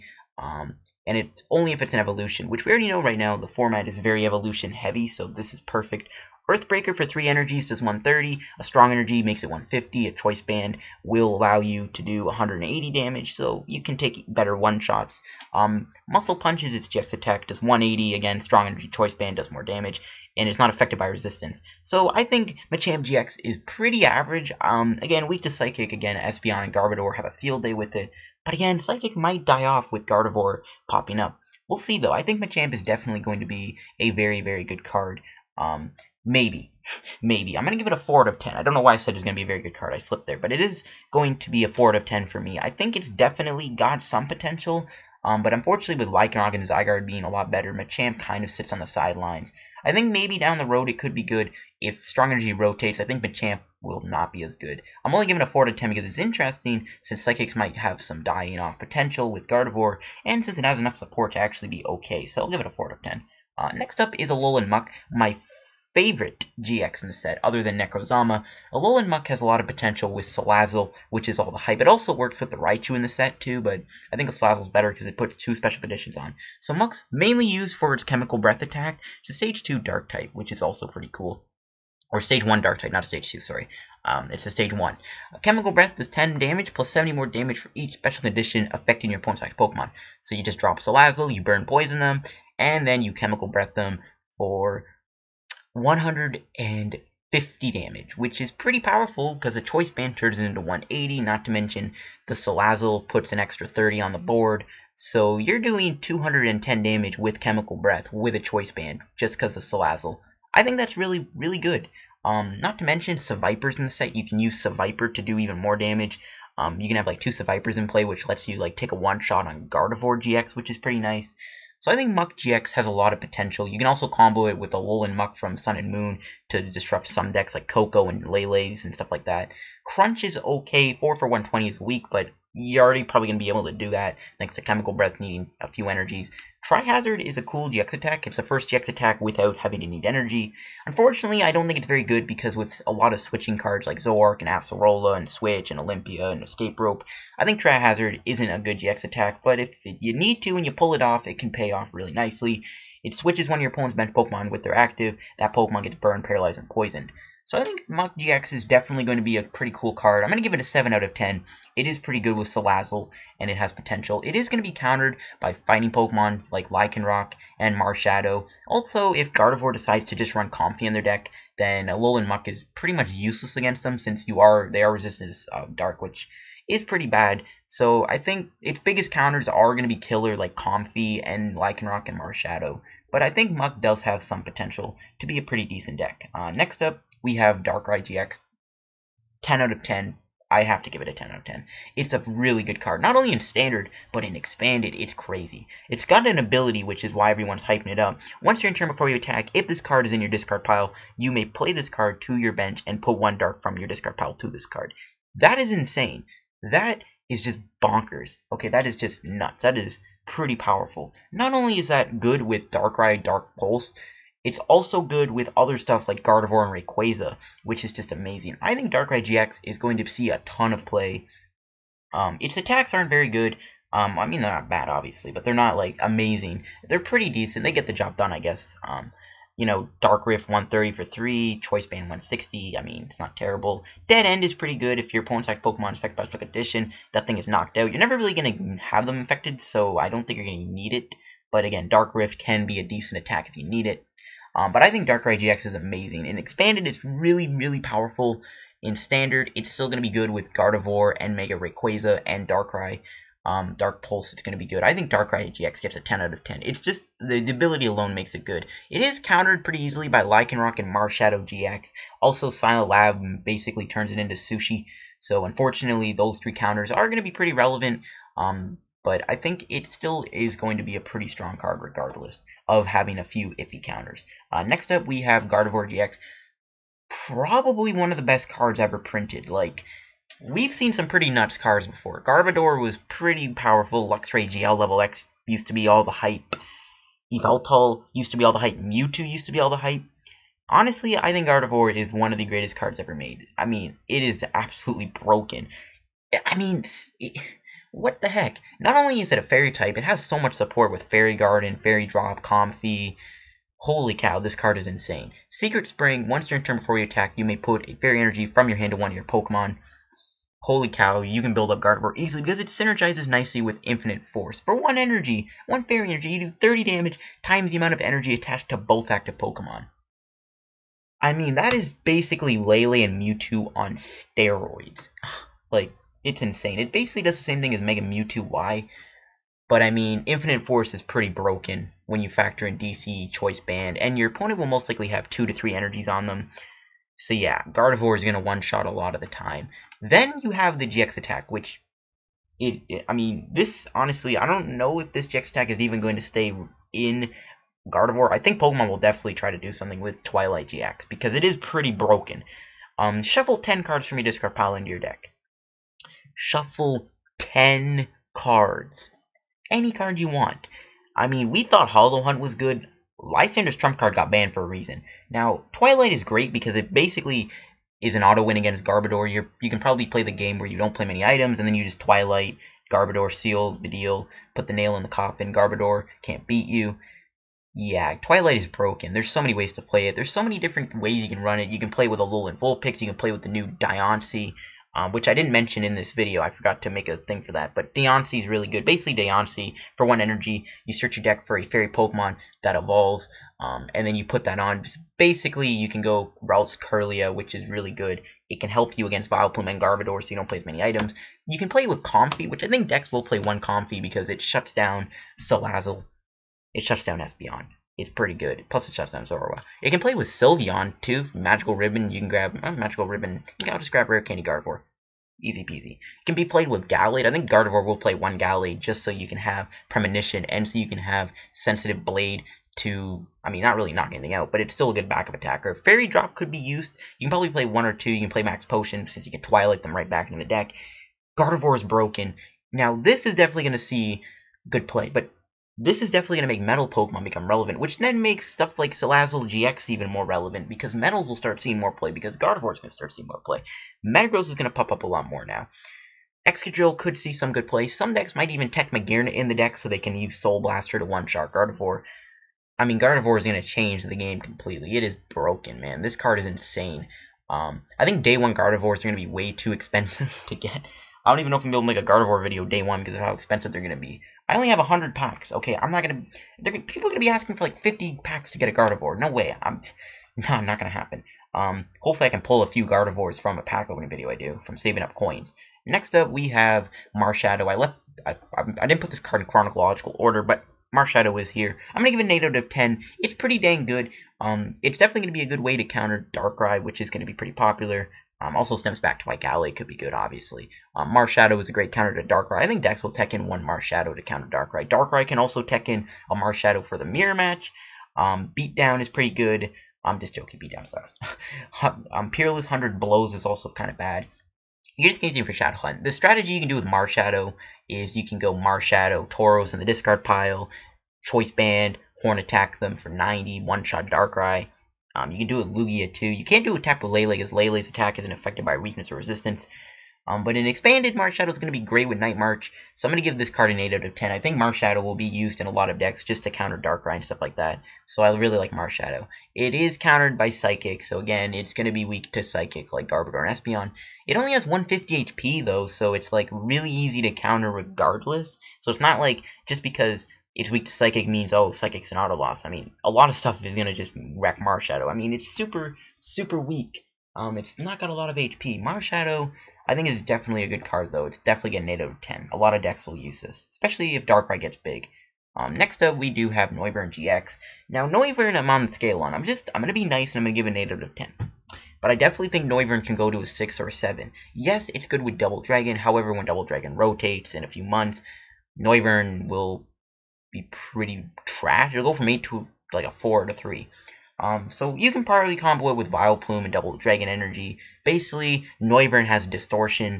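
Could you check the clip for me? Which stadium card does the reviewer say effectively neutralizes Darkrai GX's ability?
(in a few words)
Silent Lab.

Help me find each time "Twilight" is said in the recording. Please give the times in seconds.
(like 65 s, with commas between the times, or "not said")
350 s, 365 s, 372 s, 378 s, 429 s.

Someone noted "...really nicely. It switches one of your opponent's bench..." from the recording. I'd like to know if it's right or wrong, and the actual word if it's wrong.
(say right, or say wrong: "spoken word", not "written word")
right.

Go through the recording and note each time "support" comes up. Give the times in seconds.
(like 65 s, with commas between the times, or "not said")
60 s, 300 s.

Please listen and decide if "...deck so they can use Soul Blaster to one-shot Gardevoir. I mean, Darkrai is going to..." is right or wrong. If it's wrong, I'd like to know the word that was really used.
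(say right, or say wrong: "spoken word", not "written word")
wrong: "Gardevoir", not "Darkrai".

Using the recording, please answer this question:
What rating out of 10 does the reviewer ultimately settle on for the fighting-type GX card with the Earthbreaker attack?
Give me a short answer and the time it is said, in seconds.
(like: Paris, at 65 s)
4, at 37 s.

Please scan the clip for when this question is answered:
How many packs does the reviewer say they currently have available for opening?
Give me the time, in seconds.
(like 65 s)
464 s.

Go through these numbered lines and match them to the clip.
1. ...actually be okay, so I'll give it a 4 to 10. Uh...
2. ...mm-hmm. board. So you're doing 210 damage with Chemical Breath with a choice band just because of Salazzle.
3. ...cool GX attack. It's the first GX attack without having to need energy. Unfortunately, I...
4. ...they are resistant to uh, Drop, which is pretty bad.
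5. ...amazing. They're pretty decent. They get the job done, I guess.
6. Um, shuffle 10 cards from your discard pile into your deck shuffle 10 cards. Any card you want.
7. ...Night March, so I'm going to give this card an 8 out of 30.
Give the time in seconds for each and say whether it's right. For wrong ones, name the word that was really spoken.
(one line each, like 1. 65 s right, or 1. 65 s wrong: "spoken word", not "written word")
1. 61 s right
2. 104 s right
3. 137 s right
4. 174 s wrong: "Dark", not "Drop"
5. 226 s right
6. 352 s right
7. 522 s wrong: "10", not "30".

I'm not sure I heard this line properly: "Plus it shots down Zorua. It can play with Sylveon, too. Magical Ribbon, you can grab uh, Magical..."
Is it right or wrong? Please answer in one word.
right.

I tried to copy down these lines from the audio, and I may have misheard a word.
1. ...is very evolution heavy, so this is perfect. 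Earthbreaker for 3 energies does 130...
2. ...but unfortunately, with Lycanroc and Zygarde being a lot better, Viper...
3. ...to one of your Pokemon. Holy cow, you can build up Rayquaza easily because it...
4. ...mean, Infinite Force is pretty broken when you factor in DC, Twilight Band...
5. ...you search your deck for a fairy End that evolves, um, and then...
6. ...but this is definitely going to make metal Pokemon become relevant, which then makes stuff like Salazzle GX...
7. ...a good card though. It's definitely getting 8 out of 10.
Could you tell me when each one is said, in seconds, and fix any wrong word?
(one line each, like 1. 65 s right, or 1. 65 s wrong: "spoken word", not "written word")
1. 3 s right
2. 45 s wrong: "Machamp", not "Viper"
3. 308 s wrong: "Gardevoir", not "Rayquaza"
4. 329 s wrong: "Choice", not "Twilight"
5. 390 s wrong: "Pokemon", not "End"
6. 435 s right
7. 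550 s right.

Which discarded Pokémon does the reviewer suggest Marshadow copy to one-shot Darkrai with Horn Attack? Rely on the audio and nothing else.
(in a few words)
Tauros.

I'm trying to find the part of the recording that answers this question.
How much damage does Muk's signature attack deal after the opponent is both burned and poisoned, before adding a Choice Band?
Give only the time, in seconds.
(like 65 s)
95 s.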